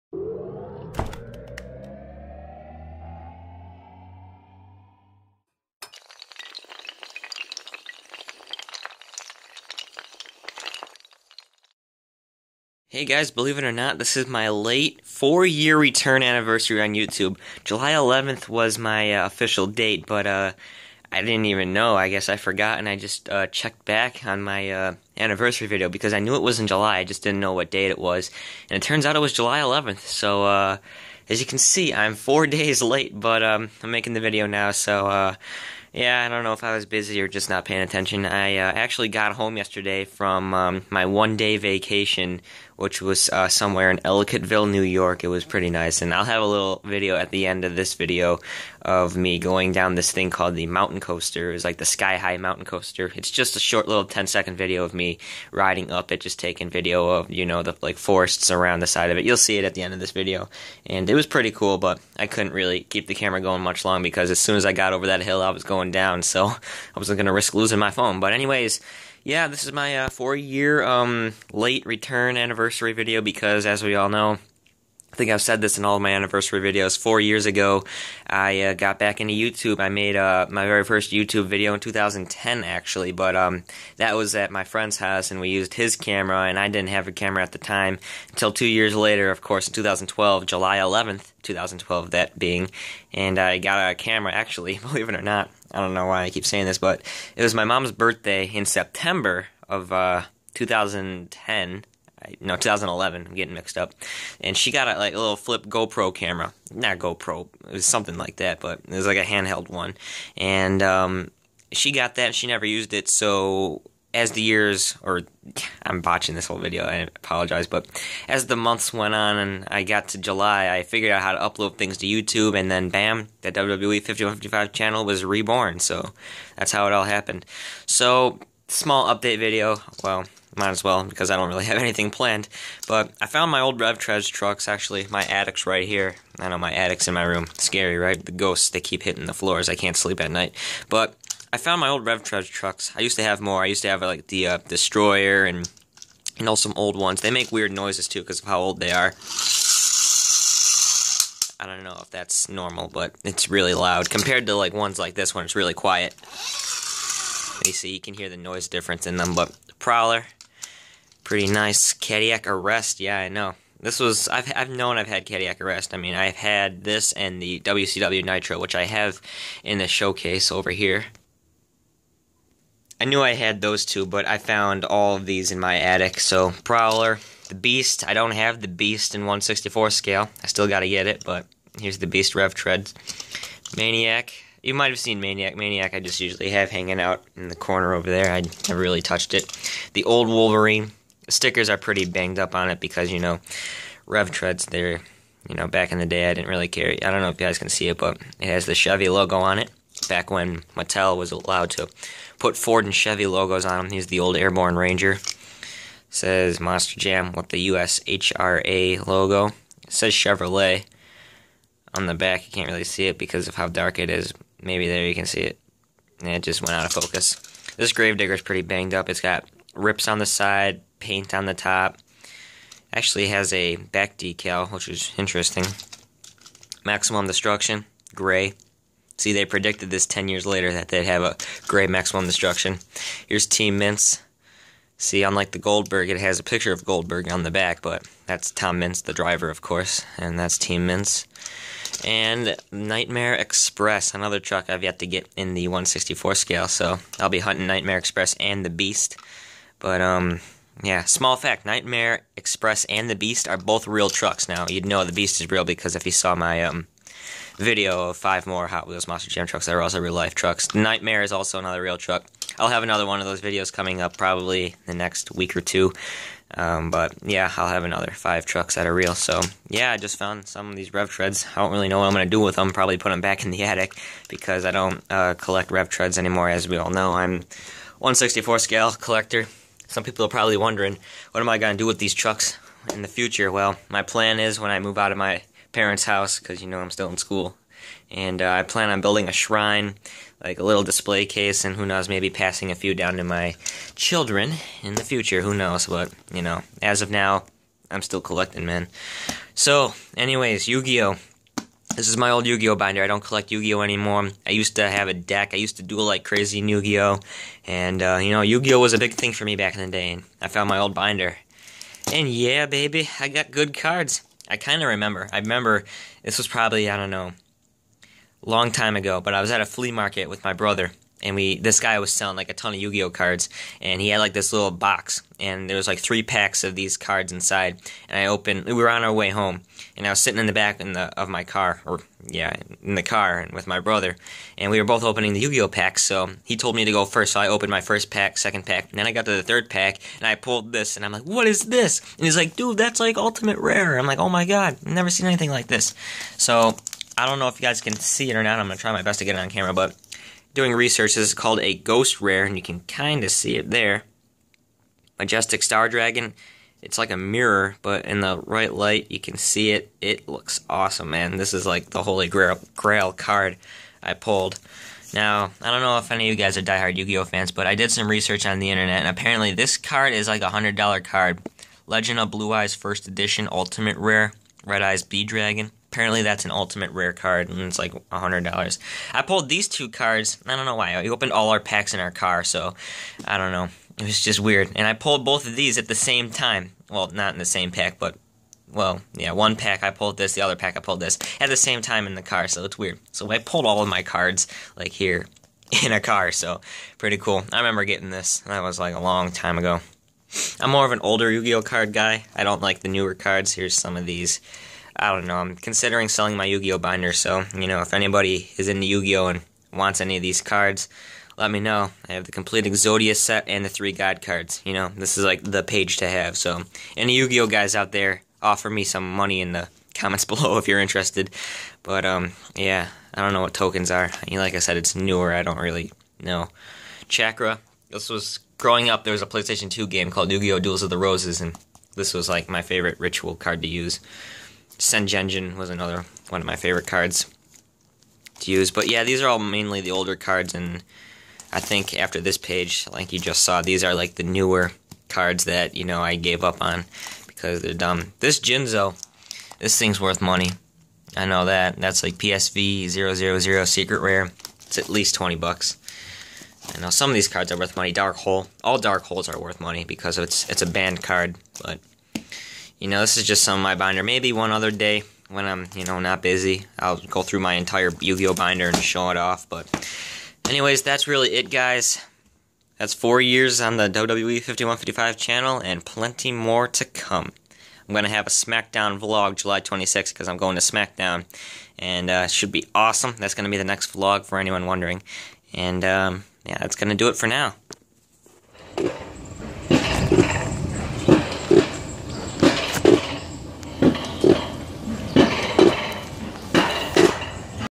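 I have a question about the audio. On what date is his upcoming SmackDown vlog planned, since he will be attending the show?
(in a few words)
July 26th.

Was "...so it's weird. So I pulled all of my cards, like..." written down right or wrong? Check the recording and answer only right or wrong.
right.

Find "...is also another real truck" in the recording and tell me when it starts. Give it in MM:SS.
04:21.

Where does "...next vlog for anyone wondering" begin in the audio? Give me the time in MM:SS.
08:03.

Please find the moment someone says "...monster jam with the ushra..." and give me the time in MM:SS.
03:26.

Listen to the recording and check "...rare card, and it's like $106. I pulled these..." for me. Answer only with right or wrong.
wrong.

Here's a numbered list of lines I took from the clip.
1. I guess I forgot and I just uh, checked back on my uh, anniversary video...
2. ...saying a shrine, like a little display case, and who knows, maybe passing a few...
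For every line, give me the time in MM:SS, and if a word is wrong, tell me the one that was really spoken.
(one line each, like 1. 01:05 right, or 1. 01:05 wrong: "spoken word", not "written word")
1. 00:21 right
2. 04:49 wrong: "building", not "saying".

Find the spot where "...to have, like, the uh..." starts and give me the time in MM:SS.
02:23.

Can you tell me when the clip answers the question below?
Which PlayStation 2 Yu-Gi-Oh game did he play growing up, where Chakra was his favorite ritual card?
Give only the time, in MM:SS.
07:10.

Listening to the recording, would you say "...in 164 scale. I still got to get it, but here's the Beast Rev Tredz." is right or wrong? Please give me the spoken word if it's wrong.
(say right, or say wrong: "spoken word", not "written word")
right.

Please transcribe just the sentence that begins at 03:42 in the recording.
Actually has a back decal, which is interesting.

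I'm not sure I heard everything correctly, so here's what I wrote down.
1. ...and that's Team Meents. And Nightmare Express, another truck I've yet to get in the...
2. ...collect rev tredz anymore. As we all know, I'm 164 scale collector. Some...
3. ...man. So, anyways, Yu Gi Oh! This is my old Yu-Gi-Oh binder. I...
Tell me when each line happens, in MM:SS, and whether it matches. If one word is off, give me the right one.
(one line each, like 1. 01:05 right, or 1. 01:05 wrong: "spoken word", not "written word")
1. 04:00 right
2. 04:35 right
3. 04:58 right.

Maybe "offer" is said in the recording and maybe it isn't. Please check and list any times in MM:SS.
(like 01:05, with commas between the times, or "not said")
06:58.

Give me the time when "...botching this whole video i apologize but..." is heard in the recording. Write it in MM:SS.
01:56.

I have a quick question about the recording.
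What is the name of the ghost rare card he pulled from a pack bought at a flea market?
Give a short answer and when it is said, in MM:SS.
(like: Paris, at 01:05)
Majestic Star Dragon, at 05:55.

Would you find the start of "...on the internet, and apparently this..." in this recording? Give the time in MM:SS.
06:08.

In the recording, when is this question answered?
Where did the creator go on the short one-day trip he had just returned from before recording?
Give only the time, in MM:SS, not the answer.
00:43.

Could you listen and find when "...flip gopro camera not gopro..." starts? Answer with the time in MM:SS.
01:45.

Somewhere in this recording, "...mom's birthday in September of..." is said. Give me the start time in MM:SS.
01:37.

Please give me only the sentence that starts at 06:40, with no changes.
I'm more of an older Yu-Gi-Oh card guy.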